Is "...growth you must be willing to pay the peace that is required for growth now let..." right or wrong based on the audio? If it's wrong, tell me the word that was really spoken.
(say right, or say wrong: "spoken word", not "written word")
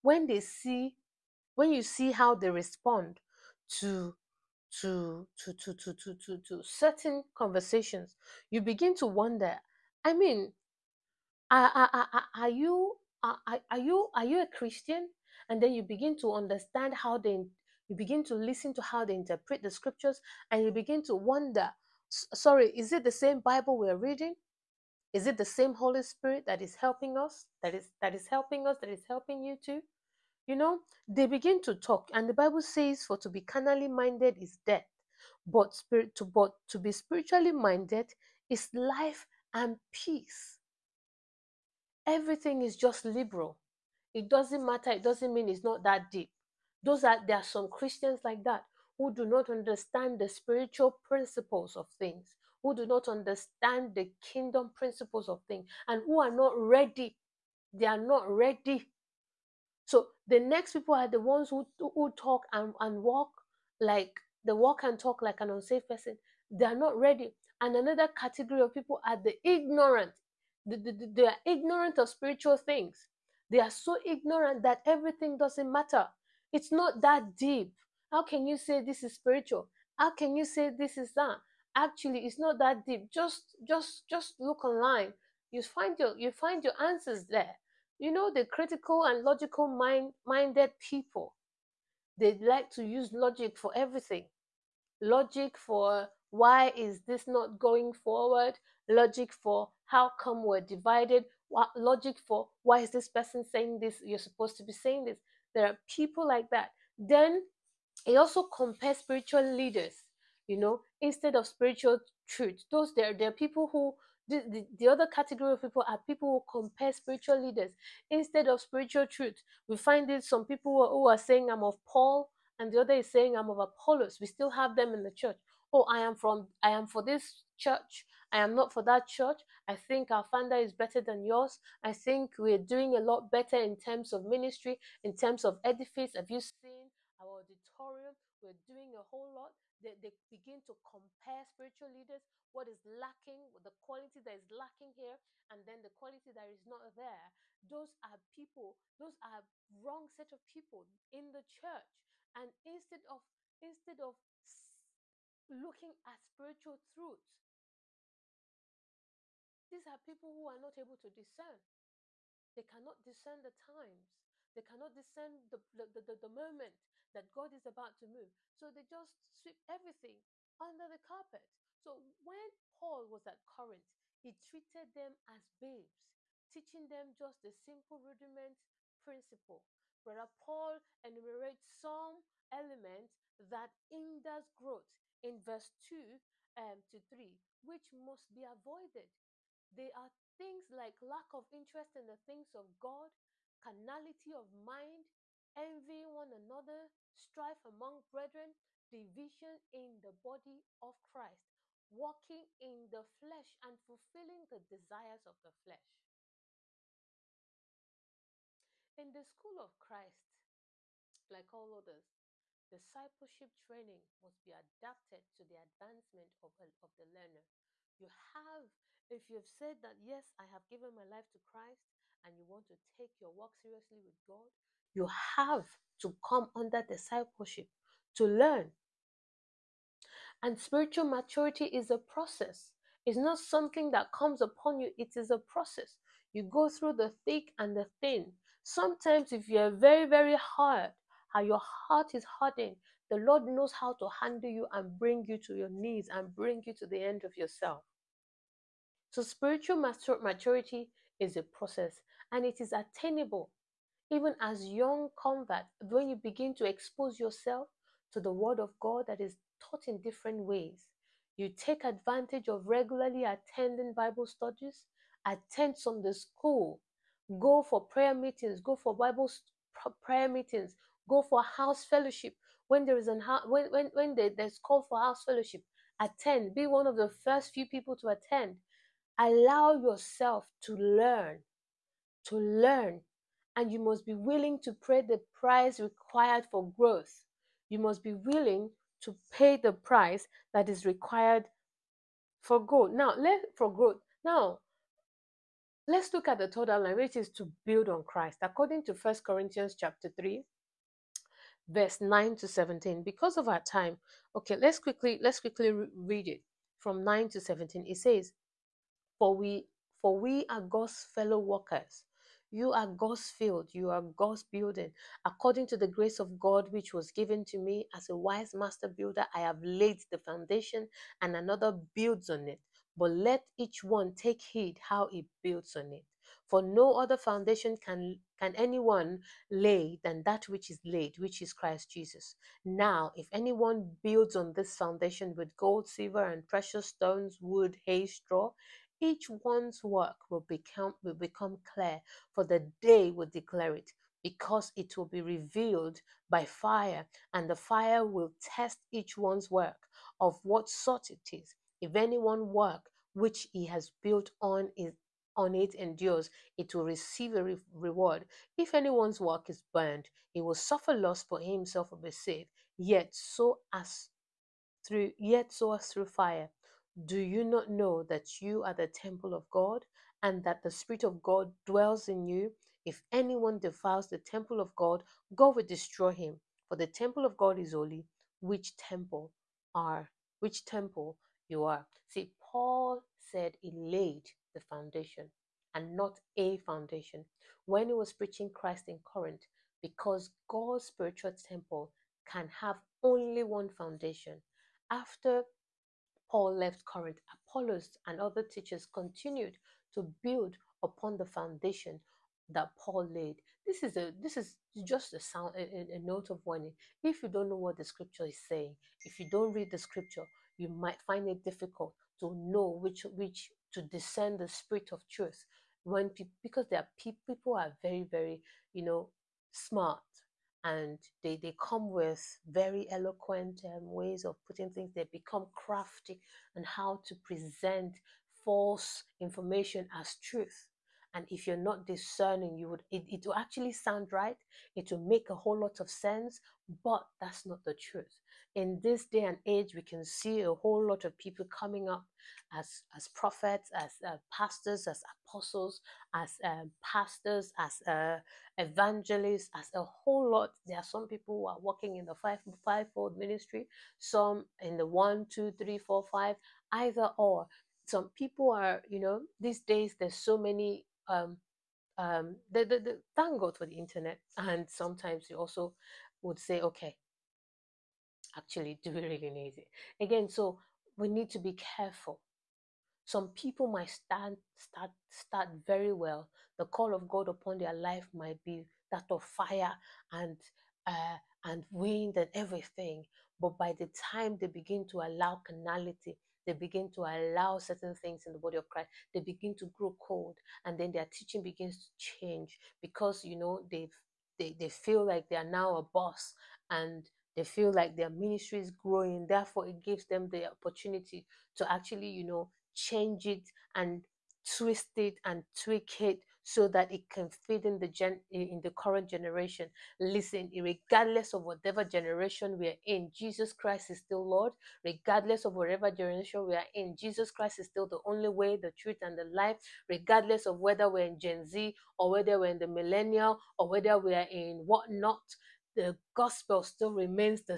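wrong: "price", not "peace".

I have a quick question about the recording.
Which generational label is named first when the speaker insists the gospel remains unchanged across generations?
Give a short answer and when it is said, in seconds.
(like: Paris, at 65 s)
Gen Z, at 521 s.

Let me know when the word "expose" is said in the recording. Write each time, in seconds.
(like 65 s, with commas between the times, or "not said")
256 s.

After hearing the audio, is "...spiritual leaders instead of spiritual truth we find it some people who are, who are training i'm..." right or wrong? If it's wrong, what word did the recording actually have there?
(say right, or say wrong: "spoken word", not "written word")
wrong: "saying", not "training".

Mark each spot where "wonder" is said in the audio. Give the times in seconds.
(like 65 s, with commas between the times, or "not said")
9 s, 21 s.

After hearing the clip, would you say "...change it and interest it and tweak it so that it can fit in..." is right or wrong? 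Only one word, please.
wrong.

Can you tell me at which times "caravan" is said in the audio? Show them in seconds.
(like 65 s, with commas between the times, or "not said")
not said.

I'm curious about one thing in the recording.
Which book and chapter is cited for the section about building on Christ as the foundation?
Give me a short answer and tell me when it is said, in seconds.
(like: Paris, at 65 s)
First Corinthians 3, at 298 s.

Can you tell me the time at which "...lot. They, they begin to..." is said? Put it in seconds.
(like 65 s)
139 s.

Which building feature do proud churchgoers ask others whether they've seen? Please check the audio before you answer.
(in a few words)
Our auditorium.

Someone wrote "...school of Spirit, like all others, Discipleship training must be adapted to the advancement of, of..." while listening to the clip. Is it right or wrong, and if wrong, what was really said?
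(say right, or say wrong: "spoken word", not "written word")
wrong: "Christ", not "Spirit".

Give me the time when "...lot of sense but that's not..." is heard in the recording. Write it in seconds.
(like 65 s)
435 s.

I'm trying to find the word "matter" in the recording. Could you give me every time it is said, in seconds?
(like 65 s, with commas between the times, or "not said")
44 s, 75 s.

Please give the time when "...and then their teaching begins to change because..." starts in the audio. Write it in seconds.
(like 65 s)
490 s.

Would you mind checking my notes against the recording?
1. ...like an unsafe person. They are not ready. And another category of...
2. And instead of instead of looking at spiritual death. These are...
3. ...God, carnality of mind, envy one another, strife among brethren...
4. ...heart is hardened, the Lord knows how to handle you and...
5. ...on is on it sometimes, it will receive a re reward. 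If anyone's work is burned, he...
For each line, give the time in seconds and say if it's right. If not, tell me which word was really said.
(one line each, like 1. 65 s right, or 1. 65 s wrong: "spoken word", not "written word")
1. 65 s right
2. 152 s wrong: "truth", not "death"
3. 192 s right
4. 241 s right
5. 354 s wrong: "endures", not "sometimes".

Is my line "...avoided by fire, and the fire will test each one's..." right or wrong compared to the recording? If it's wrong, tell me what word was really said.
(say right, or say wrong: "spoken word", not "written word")
wrong: "revealed", not "avoided".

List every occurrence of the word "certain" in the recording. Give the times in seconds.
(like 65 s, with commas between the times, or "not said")
6 s, 487 s.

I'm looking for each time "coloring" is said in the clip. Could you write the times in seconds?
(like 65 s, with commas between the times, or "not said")
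not said.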